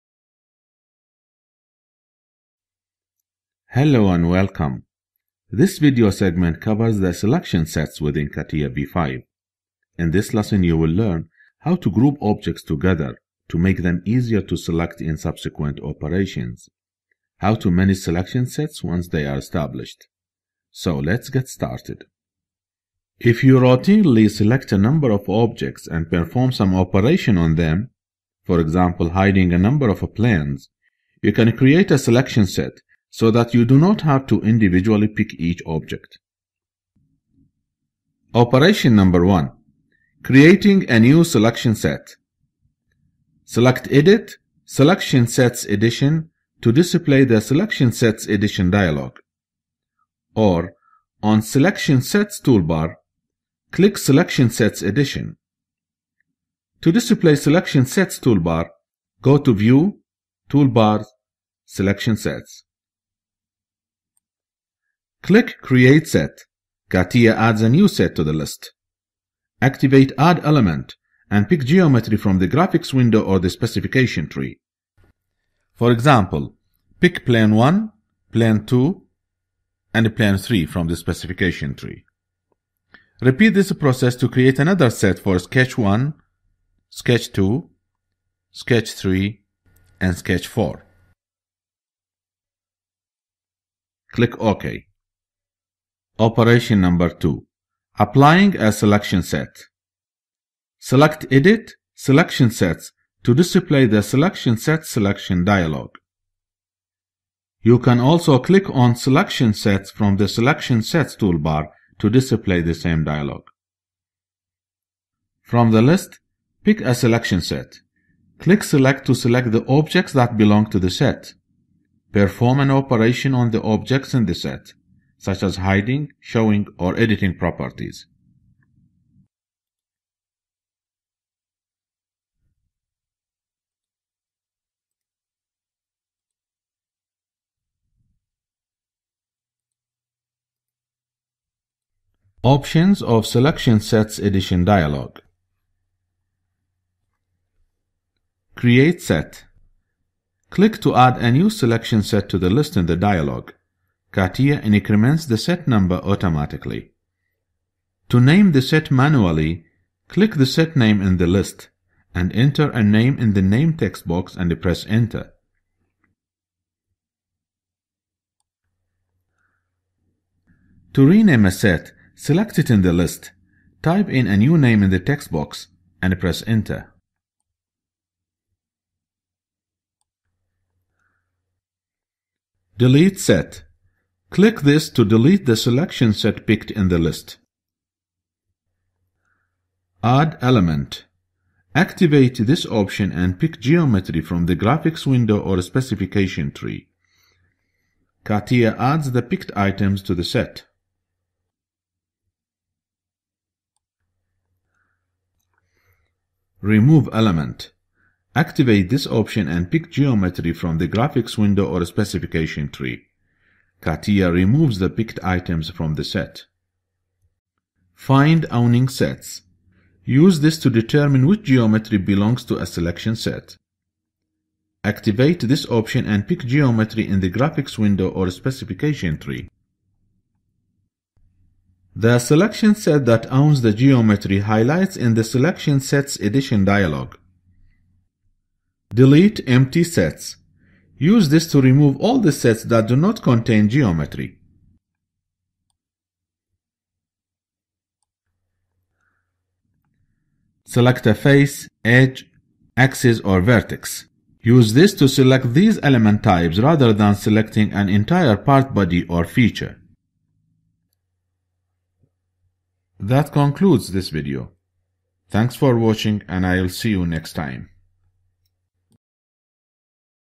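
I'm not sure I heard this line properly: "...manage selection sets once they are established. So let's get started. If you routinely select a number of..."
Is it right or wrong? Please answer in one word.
right.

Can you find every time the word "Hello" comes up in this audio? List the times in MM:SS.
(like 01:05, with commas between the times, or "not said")
00:03.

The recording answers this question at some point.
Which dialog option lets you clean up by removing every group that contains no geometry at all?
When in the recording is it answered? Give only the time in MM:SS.
03:58.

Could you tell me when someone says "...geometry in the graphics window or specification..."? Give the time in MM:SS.
03:46.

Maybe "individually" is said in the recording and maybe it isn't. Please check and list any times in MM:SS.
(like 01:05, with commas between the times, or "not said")
00:34.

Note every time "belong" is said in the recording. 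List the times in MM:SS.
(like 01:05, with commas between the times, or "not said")
02:00, 03:41.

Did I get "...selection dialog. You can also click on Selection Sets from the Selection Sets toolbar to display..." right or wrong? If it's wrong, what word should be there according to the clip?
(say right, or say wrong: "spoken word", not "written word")
right.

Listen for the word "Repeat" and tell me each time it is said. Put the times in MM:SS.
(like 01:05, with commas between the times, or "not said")
01:23.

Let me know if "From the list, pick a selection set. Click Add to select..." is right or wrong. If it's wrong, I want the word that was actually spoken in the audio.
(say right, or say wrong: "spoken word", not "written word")
wrong: "Select", not "Add".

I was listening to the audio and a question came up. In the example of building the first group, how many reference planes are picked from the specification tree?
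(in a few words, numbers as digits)
3.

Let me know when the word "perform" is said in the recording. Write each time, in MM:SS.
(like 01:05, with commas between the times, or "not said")
00:26, 02:02.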